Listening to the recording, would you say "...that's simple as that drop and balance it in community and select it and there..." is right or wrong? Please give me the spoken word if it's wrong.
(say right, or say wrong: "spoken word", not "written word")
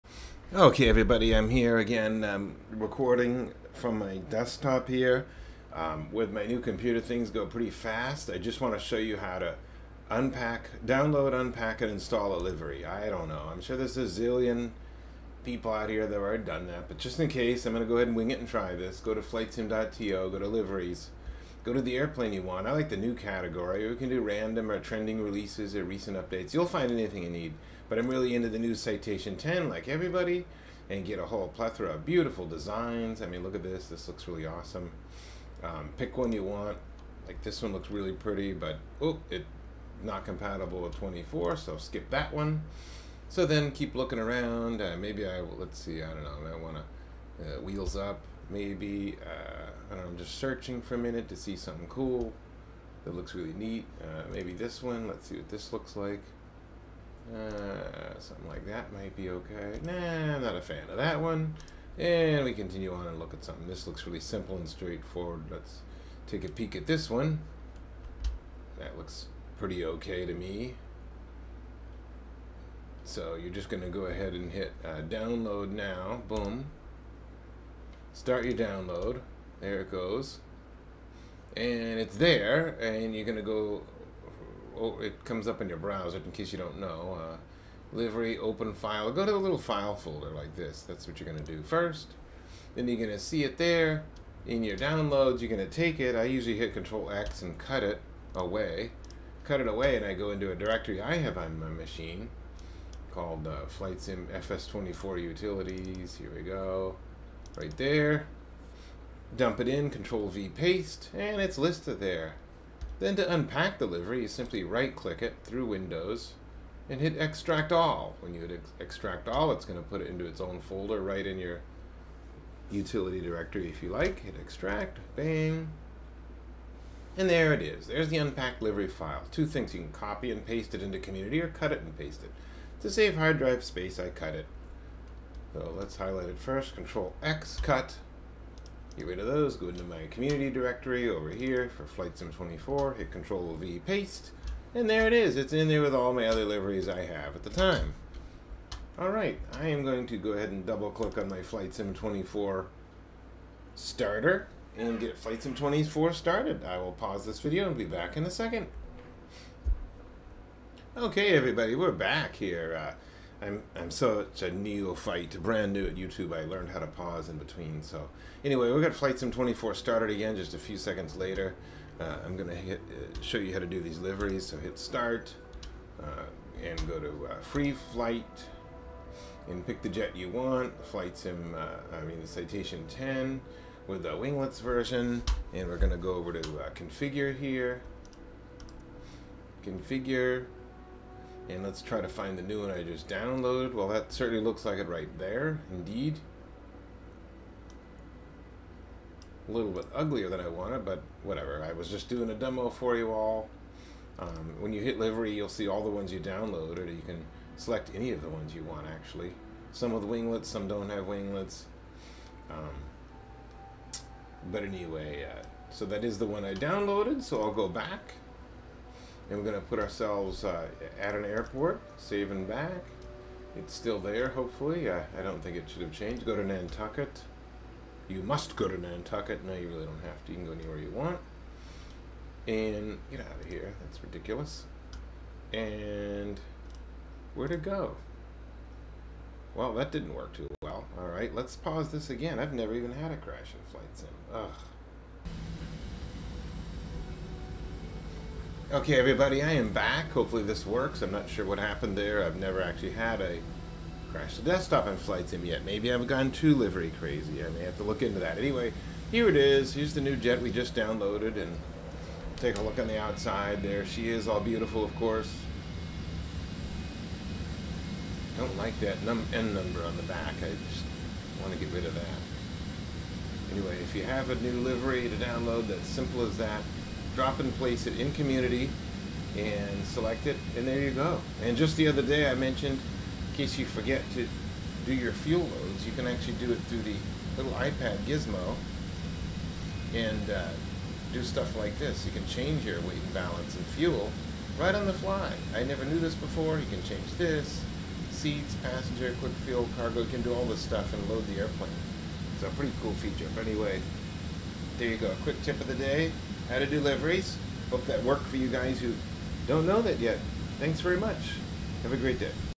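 wrong: "place", not "balance".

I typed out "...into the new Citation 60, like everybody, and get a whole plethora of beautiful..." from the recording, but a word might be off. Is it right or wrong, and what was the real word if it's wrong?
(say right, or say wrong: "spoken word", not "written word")
wrong: "10", not "60".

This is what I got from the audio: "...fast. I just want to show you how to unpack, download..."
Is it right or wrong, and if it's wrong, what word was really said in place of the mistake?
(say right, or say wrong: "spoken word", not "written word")
right.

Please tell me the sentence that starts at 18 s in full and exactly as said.
Go to flightsim.to, go to liveries, Go to the airplane you want.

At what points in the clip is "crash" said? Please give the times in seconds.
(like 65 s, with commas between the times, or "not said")
243 s, 254 s.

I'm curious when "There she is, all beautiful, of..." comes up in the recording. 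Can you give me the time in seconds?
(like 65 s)
263 s.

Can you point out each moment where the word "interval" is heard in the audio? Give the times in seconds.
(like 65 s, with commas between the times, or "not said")
not said.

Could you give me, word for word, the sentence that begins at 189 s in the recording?
Configure and let's try to find the new one I just downloaded.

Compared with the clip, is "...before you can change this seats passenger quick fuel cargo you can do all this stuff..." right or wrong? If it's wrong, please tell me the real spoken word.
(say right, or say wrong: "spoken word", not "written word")
right.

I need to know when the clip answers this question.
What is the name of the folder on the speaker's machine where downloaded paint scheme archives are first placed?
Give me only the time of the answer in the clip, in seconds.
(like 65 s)
103 s.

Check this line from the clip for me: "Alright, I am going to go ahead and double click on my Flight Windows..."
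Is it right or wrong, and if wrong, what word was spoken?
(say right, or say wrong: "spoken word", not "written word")
wrong: "Sim", not "Windows".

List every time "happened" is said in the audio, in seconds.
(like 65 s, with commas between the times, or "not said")
251 s.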